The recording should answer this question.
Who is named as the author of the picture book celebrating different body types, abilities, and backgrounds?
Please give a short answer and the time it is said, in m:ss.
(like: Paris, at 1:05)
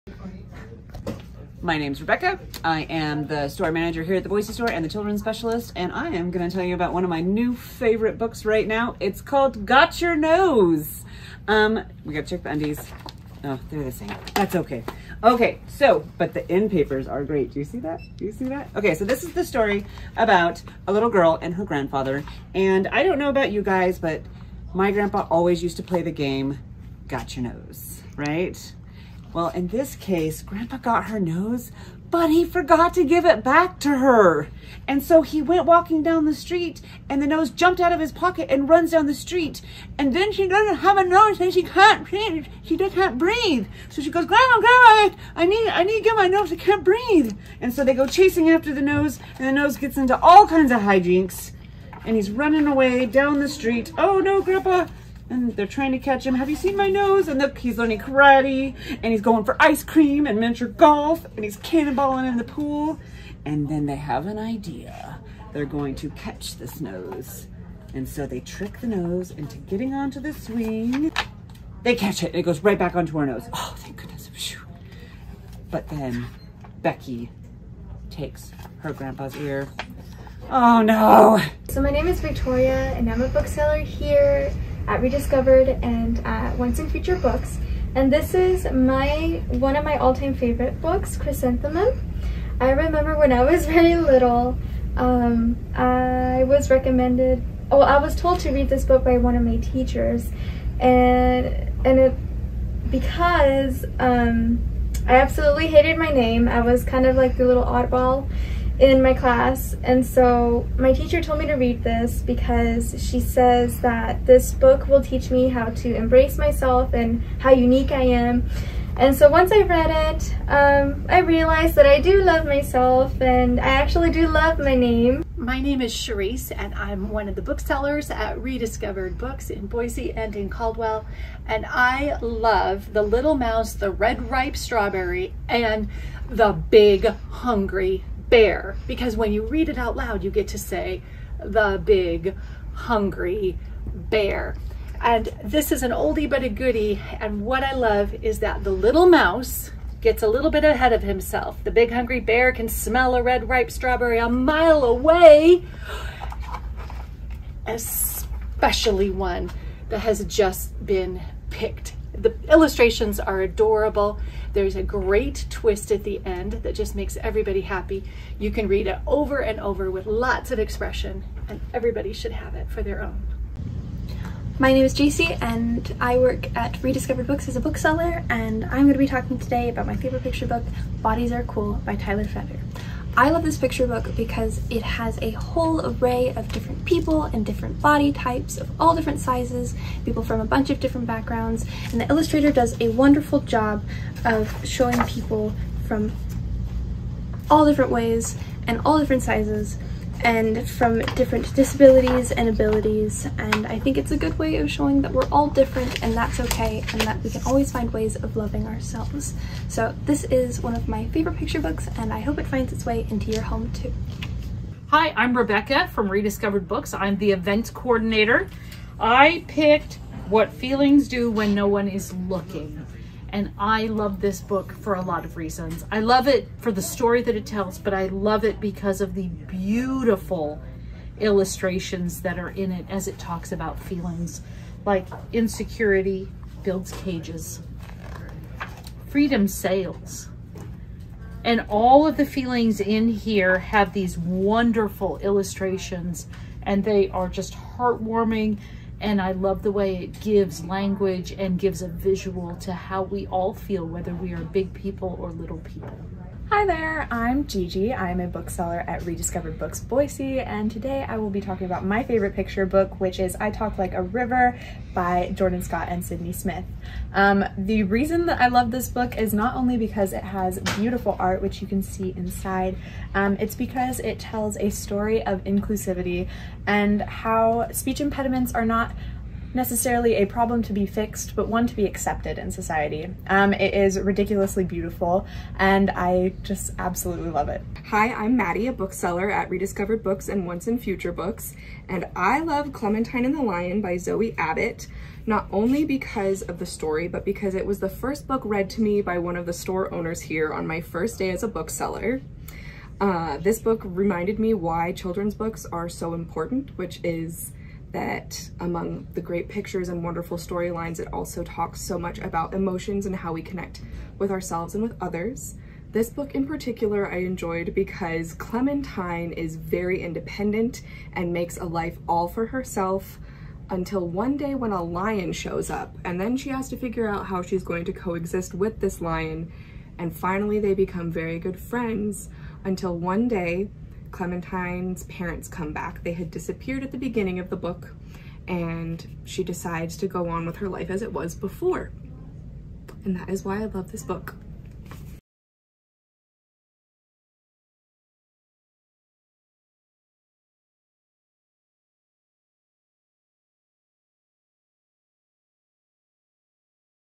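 Tyler Feder, at 3:01.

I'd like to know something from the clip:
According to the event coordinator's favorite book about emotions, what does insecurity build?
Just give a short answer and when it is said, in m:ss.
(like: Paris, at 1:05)
cages, at 3:56.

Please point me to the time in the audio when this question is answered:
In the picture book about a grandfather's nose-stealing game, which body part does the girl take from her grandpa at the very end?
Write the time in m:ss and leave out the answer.
1:19.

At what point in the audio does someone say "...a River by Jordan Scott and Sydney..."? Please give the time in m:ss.
4:23.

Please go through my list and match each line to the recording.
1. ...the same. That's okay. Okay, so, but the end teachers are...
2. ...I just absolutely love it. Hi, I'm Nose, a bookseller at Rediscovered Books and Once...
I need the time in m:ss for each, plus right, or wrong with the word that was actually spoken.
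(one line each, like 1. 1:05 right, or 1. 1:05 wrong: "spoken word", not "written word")
1. 0:13 wrong: "papers", not "teachers"
2. 4:45 wrong: "Maddie", not "Nose".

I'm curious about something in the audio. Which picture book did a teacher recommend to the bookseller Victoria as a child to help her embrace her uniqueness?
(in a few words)
Chrysanthemum.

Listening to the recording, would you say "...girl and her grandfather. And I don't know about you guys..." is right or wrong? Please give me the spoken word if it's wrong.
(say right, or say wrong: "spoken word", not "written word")
right.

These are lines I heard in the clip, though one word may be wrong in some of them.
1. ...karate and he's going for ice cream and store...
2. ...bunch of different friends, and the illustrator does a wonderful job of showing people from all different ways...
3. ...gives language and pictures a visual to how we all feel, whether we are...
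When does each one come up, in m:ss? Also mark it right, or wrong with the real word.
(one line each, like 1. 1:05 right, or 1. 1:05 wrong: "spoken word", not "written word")
1. 0:57 wrong: "miniature", not "store"
2. 3:10 wrong: "backgrounds", not "friends"
3. 4:10 wrong: "gives", not "pictures".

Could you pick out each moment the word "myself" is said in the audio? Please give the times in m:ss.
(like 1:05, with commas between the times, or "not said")
1:56, 2:02.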